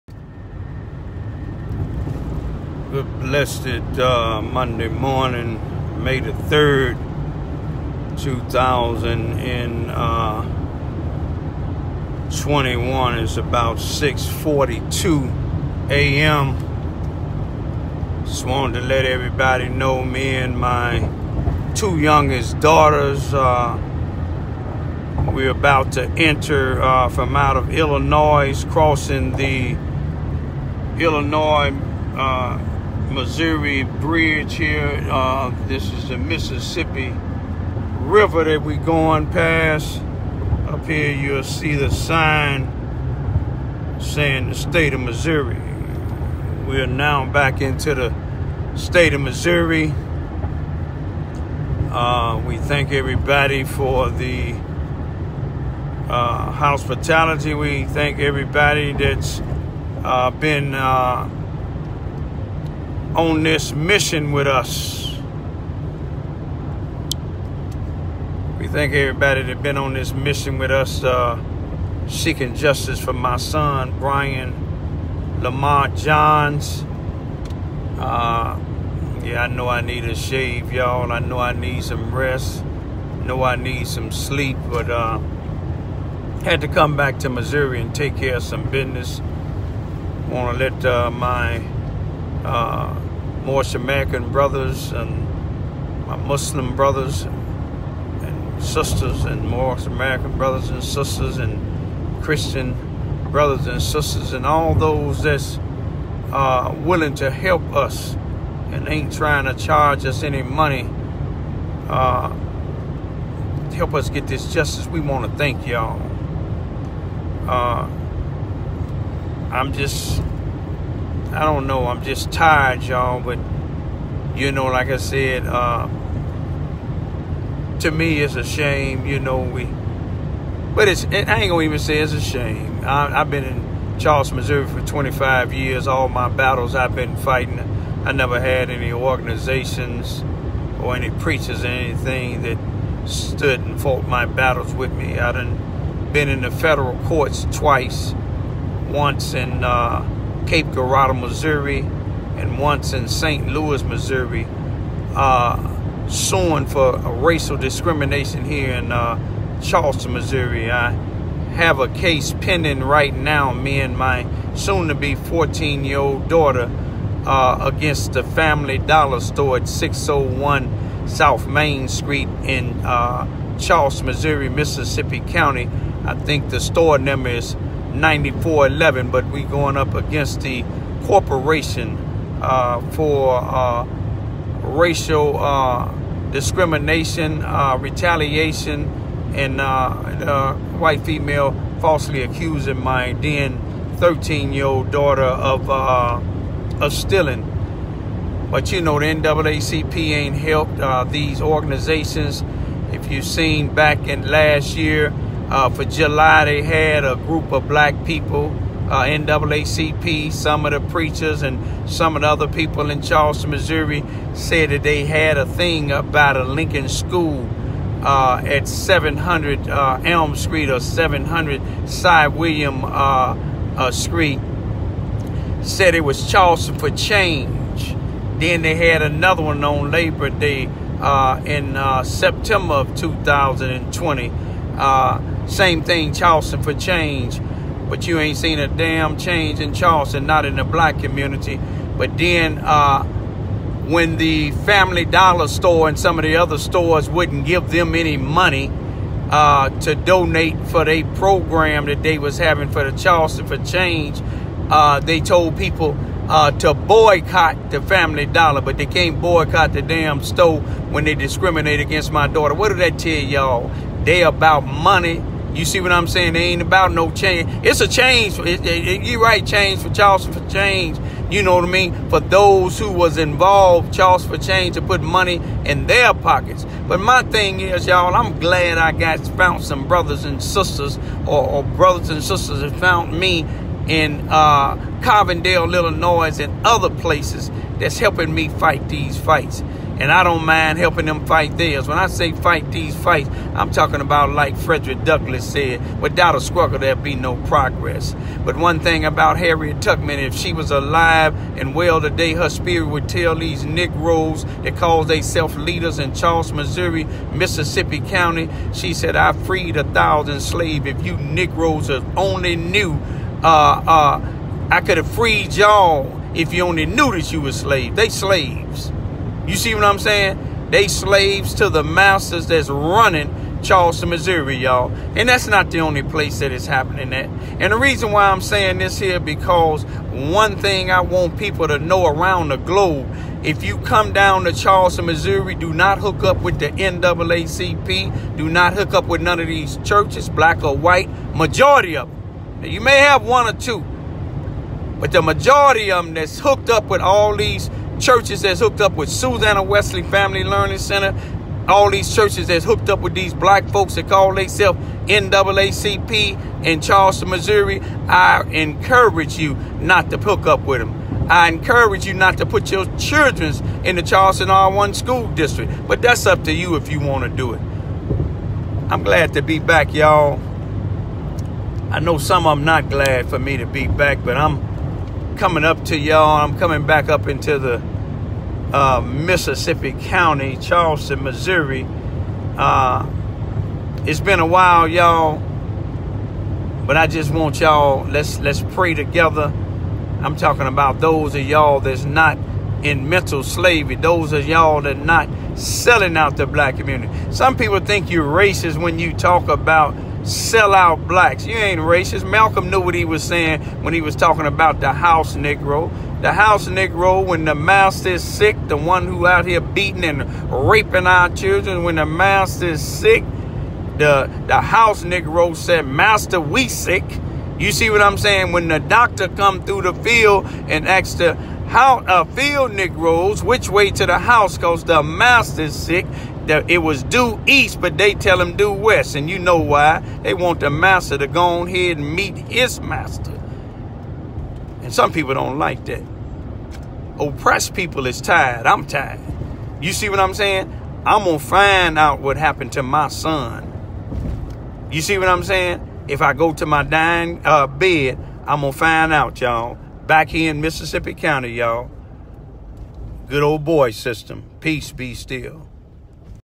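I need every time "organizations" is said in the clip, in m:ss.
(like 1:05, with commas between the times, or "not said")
2:18, 3:21.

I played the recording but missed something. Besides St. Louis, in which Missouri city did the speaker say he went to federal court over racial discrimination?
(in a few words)
Cape Girardeau.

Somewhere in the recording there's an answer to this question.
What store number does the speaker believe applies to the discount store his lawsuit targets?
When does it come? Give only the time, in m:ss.
2:57.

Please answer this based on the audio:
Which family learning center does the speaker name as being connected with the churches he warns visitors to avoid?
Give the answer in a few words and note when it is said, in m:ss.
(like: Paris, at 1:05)
Susanna Wesley Family Learning Center, at 5:49.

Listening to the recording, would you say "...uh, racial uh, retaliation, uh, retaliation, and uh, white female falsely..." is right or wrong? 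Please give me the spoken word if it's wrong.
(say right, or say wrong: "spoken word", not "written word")
wrong: "discrimination", not "retaliation".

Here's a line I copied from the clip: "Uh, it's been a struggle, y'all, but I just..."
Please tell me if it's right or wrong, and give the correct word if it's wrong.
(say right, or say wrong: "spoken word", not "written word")
wrong: "while", not "struggle".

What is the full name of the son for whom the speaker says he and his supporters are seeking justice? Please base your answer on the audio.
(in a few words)
Brian Lamar Johns.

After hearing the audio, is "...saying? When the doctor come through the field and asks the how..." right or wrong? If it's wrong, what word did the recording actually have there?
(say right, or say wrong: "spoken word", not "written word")
right.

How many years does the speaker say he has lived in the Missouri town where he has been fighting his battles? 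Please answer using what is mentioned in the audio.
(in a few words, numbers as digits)
25.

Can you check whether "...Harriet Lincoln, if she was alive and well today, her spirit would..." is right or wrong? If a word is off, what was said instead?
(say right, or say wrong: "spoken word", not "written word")
wrong: "Tubman", not "Lincoln".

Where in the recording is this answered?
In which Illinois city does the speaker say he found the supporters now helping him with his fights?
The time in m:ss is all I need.
4:45.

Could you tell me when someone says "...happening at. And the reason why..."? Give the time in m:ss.
5:26.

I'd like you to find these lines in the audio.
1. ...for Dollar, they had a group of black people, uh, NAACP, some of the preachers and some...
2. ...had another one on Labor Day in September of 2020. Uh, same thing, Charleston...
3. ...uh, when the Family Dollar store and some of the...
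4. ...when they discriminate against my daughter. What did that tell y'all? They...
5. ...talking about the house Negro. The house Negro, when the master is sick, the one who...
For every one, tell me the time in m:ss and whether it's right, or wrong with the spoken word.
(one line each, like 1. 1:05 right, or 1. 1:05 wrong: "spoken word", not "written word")
1. 3:25 wrong: "July", not "Dollar"
2. 3:48 right
3. 4:02 right
4. 4:20 right
5. 6:44 right.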